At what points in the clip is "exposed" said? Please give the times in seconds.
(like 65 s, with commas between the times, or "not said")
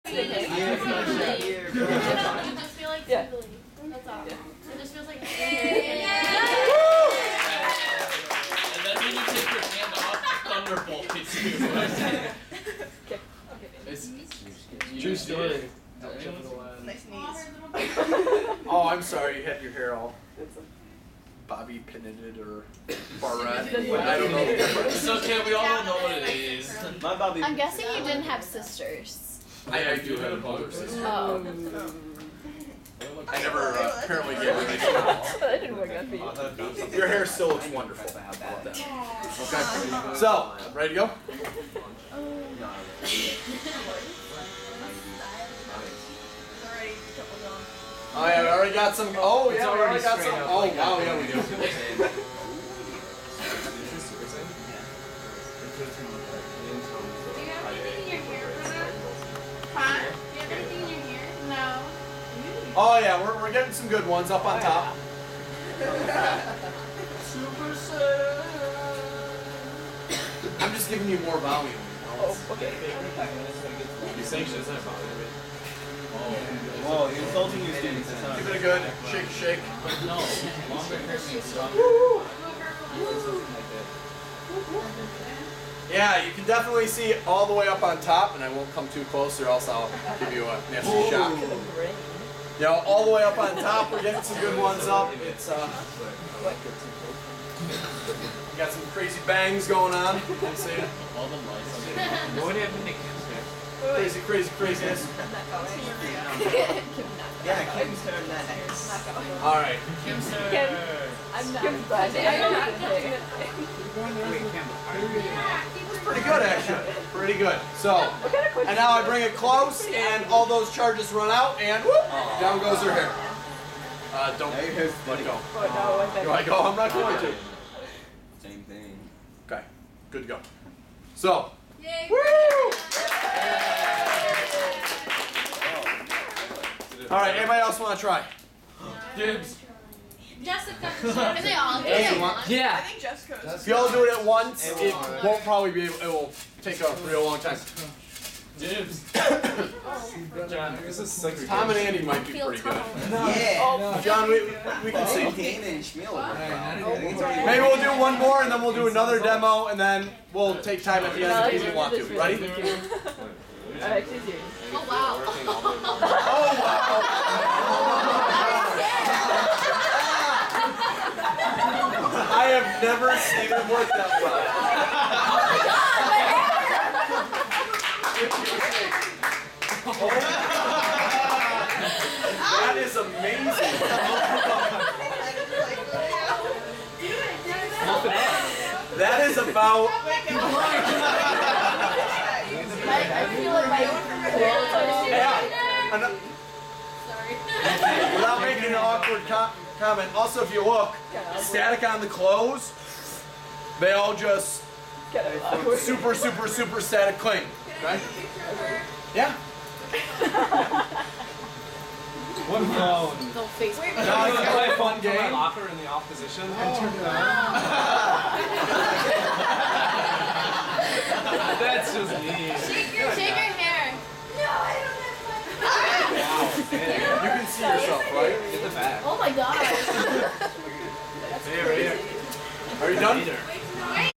not said.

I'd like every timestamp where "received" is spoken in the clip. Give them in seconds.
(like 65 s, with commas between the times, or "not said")
not said.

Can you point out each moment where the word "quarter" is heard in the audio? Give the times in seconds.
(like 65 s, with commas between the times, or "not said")
not said.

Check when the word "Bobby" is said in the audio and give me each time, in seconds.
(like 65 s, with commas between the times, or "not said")
21 s, 27 s.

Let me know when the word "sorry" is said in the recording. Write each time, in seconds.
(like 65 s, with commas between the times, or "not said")
19 s, 197 s.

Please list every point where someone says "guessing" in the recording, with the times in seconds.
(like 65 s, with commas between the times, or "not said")
27 s.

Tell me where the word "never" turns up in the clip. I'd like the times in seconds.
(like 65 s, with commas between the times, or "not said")
33 s, 172 s.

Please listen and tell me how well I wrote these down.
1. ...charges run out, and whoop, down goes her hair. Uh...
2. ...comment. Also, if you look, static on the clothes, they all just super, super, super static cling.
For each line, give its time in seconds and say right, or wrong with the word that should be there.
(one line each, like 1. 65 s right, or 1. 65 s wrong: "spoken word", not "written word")
1. 120 s right
2. 199 s right.